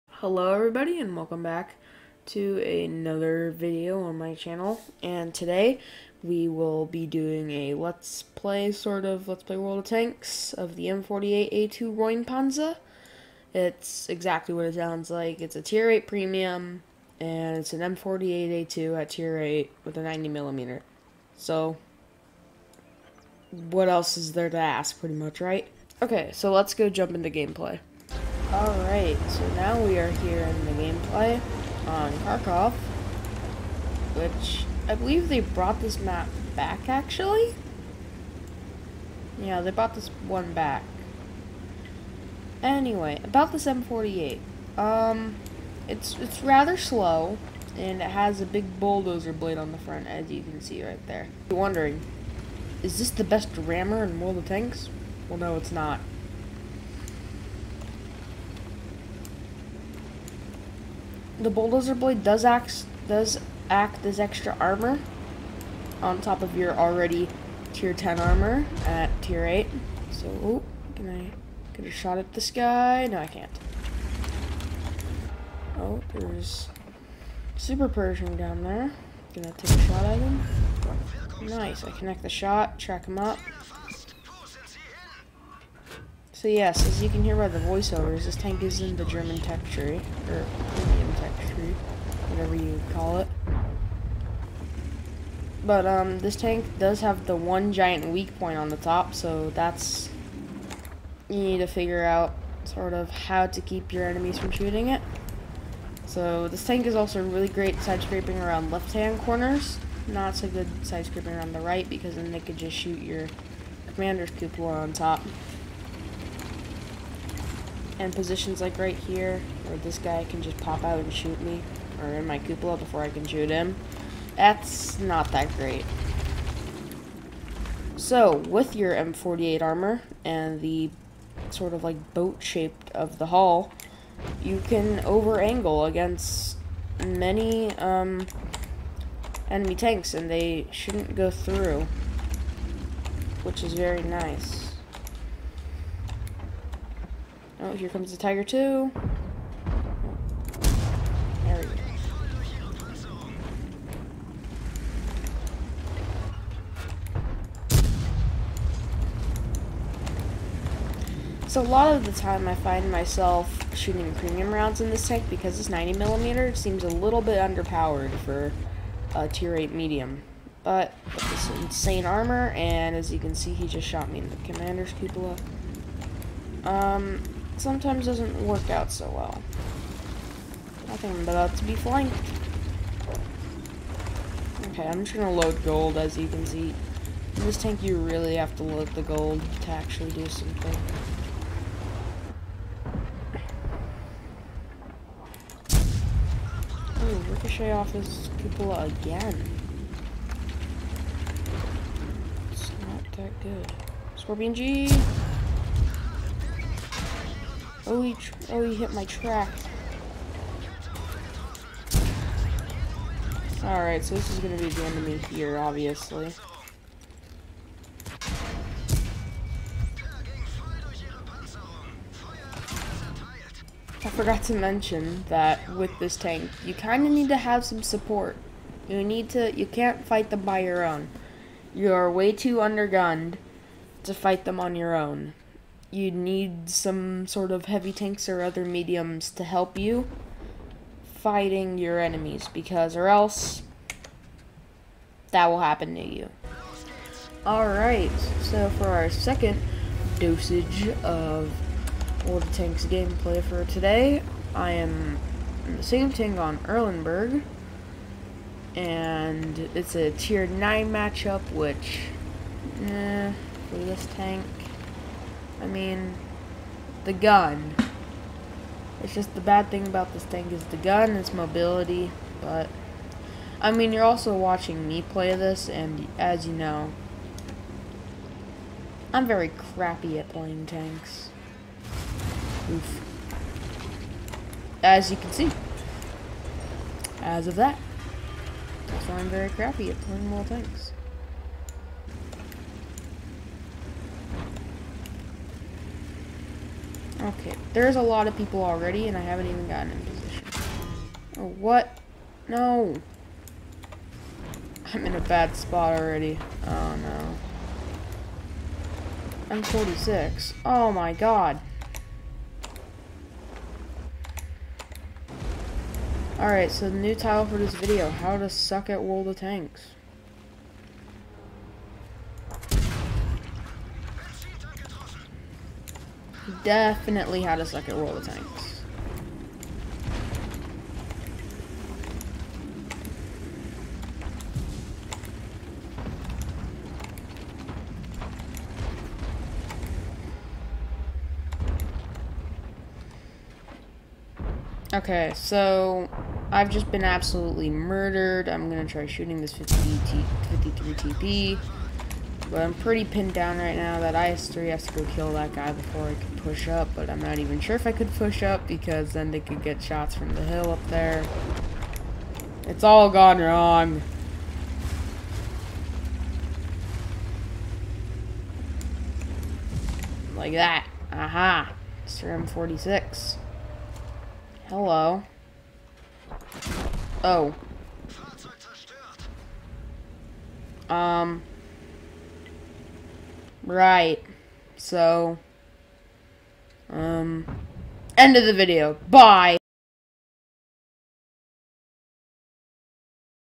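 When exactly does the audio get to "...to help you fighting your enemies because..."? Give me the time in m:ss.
3:59.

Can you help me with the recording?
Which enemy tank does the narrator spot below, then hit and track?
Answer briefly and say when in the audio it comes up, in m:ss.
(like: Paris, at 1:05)
Super Pershing, at 1:17.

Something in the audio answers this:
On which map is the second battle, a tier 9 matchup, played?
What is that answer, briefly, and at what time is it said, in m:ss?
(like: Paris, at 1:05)
Erlenberg, at 4:16.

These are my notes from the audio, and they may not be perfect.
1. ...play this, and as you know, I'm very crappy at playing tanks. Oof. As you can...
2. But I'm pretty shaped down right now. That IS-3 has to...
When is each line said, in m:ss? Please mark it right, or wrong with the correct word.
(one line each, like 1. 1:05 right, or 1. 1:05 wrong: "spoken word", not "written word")
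1. 4:35 right
2. 5:52 wrong: "pinned", not "shaped".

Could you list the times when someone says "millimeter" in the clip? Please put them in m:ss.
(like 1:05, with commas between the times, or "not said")
0:20, 2:45.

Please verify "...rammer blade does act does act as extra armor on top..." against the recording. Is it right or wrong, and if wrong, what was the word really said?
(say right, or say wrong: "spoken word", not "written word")
wrong: "bulldozer", not "rammer".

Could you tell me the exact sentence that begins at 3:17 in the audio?
Ooh, ricochet off his cupola again.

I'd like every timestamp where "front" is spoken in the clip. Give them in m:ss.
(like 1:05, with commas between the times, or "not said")
0:49.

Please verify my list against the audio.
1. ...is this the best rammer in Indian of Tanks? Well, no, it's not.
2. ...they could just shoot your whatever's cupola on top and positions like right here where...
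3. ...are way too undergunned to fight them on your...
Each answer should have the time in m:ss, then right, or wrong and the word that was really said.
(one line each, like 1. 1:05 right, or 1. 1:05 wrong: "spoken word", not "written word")
1. 0:52 wrong: "World", not "Indian"
2. 1:52 wrong: "commander", not "whatever"
3. 3:51 right.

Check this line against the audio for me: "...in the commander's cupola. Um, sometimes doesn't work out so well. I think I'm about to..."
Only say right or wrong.
right.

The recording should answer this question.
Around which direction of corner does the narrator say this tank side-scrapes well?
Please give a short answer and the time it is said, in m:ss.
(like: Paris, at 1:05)
left-hand corners, at 1:48.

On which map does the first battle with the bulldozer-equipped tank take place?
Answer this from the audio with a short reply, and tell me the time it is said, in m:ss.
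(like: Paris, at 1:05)
Kharkov, at 0:32.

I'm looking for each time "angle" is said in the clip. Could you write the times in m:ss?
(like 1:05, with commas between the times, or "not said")
2:15.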